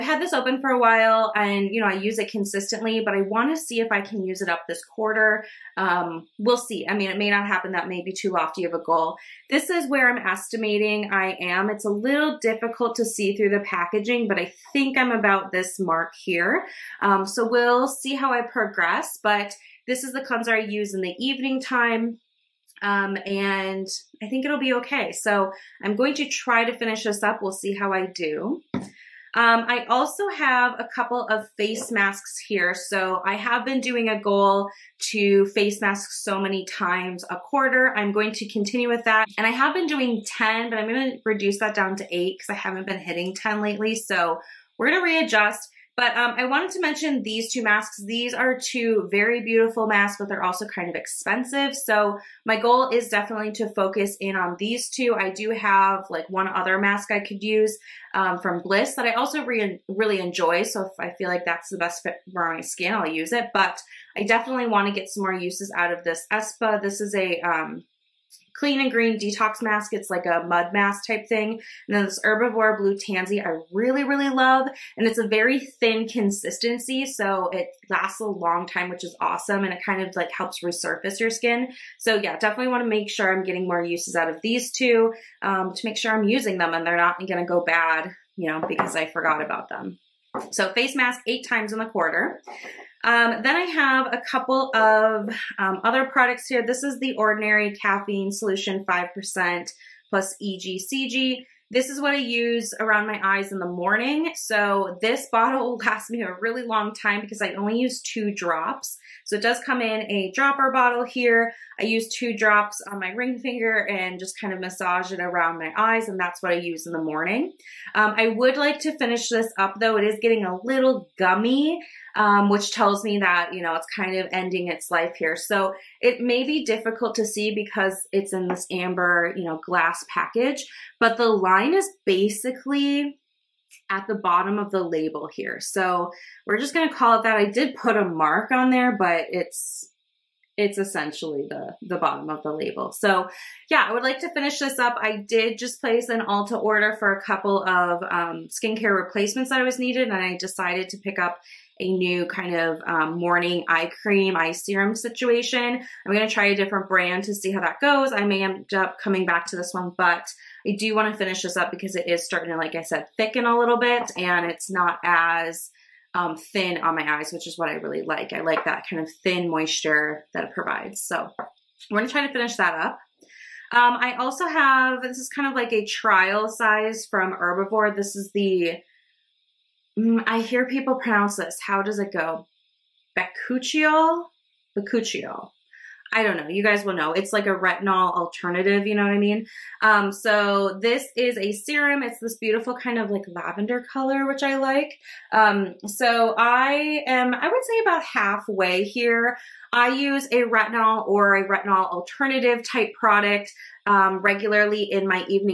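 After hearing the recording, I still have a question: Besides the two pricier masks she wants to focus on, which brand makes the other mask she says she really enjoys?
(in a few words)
Bliss.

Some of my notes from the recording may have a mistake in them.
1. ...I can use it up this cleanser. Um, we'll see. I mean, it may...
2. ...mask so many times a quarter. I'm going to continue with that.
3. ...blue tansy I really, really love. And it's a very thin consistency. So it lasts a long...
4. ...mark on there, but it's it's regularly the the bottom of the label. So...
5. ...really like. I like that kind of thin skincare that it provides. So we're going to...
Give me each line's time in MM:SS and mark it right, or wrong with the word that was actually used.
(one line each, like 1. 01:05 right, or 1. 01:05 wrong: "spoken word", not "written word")
1. 00:03 wrong: "quarter", not "cleanser"
2. 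00:35 right
3. 01:12 right
4. 02:18 wrong: "essentially", not "regularly"
5. 02:47 wrong: "moisture", not "skincare".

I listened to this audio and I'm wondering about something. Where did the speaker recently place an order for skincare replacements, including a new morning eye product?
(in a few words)
Ulta.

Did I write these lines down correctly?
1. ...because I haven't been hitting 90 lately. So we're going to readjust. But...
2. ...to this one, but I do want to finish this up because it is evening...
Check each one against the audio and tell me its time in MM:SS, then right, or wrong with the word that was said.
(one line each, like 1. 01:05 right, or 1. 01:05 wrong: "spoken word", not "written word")
1. 00:42 wrong: "10", not "90"
2. 02:39 wrong: "starting", not "evening".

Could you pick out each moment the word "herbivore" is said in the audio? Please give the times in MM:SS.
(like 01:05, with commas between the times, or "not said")
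01:12, 02:57.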